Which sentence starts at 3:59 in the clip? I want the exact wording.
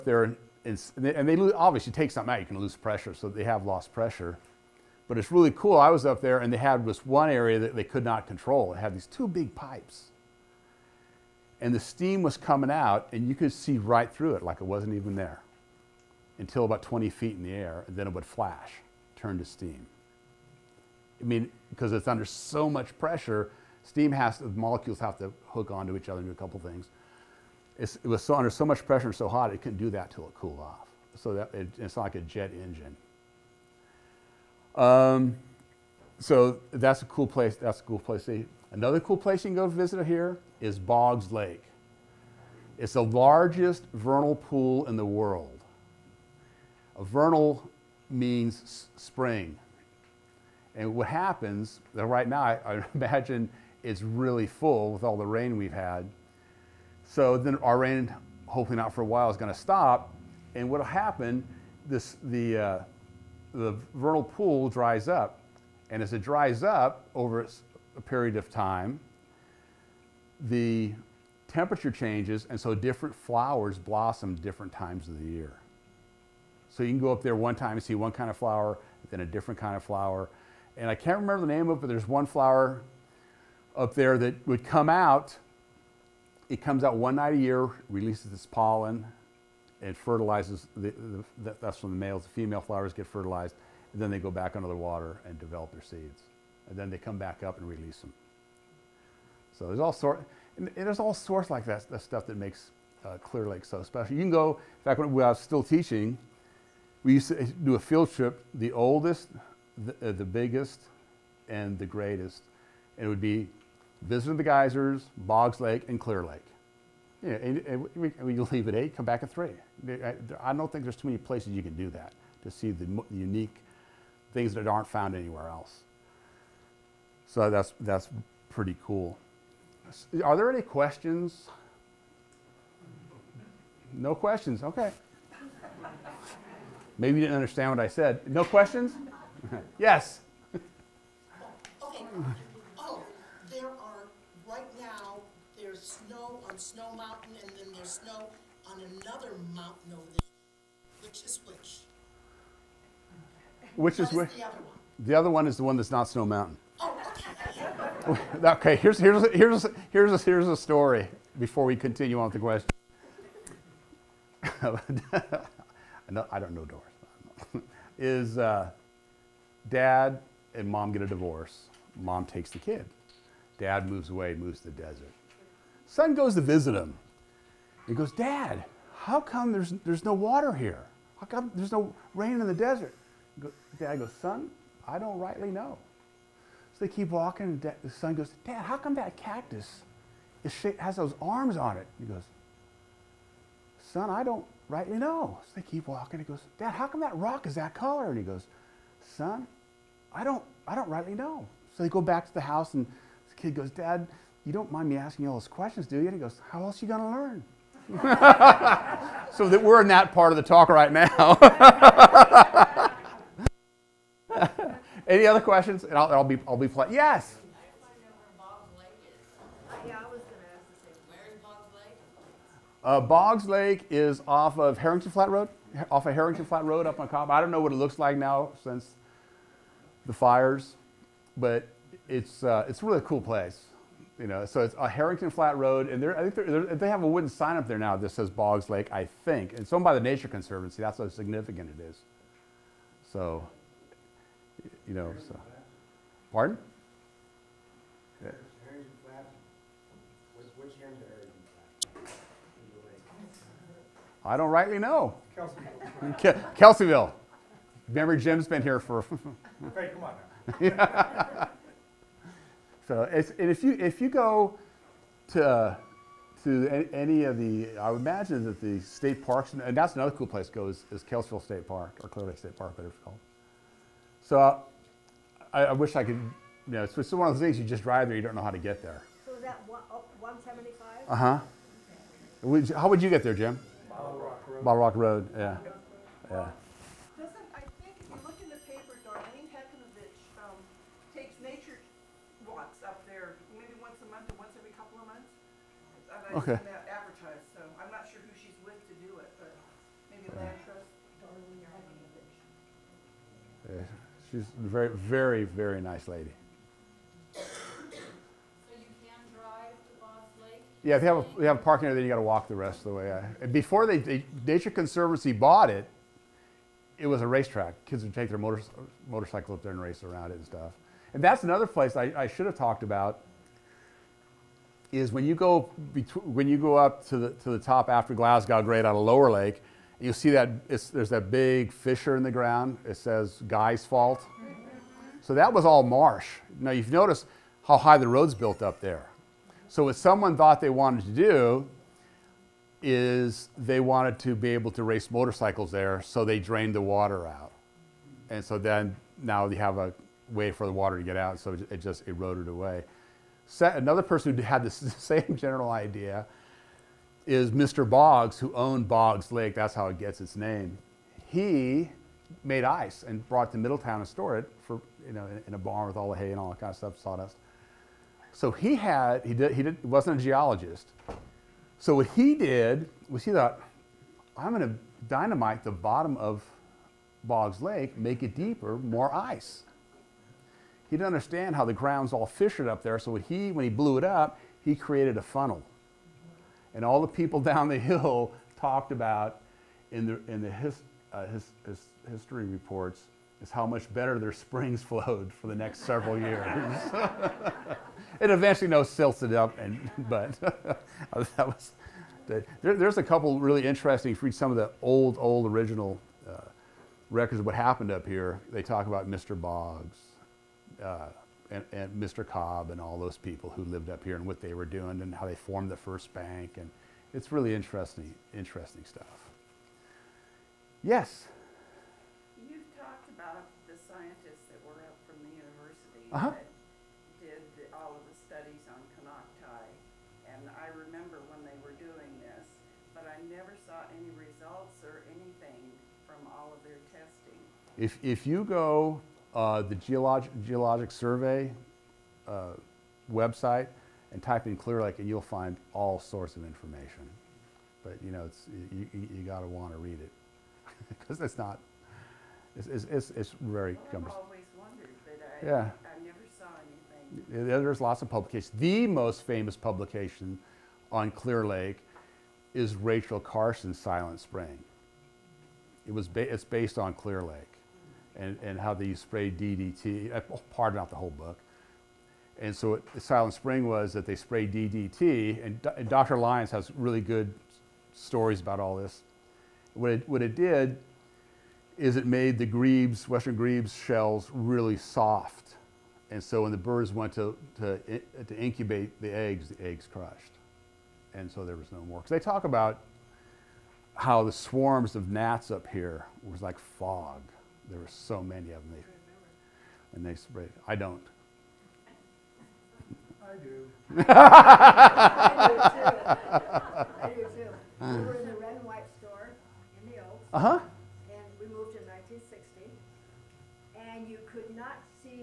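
It's owned by the Nature Conservancy.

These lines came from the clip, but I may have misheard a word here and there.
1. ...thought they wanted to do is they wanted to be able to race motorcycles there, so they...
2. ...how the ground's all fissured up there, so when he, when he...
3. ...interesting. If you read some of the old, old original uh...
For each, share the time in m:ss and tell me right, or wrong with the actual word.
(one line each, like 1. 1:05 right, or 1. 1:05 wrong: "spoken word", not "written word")
1. 5:40 right
2. 6:21 right
3. 6:43 right.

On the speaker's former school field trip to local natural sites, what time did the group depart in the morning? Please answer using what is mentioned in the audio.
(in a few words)
8.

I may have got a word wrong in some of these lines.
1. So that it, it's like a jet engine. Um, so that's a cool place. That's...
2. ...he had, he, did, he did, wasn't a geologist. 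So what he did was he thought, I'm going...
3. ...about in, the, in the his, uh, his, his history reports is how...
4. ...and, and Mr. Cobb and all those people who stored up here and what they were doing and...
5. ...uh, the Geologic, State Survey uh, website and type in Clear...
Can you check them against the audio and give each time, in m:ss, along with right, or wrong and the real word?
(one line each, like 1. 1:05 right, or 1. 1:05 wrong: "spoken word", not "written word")
1. 0:31 right
2. 6:08 right
3. 6:28 right
4. 6:51 wrong: "lived", not "stored"
5. 7:19 wrong: "Geologic", not "State".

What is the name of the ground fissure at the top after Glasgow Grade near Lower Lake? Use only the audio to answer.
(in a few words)
Guy's Fault.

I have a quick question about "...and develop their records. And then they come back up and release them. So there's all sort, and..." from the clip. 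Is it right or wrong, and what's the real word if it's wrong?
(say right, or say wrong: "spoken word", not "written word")
wrong: "seeds", not "records".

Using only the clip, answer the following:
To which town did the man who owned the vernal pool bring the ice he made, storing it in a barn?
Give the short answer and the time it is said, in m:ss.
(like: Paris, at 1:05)
Middletown, at 6:03.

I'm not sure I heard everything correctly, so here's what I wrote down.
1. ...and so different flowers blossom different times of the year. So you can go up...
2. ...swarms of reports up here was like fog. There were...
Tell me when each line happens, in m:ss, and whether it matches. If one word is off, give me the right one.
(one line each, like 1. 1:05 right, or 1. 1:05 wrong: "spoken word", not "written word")
1. 1:12 right
2. 8:14 wrong: "gnats", not "reports".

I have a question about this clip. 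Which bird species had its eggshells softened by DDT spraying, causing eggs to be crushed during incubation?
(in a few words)
Western grebes.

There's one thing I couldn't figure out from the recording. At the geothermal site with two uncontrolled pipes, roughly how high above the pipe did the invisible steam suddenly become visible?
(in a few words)
20 feet.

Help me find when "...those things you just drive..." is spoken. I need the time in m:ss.
4:37.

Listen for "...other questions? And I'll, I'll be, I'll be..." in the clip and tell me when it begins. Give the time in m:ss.
3:35.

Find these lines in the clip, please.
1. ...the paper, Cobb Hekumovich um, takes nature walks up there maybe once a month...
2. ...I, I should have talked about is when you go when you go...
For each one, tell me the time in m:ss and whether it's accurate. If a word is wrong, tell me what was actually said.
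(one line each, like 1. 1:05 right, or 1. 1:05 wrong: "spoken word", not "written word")
1. 4:48 wrong: "Darlene", not "Cobb"
2. 5:21 right.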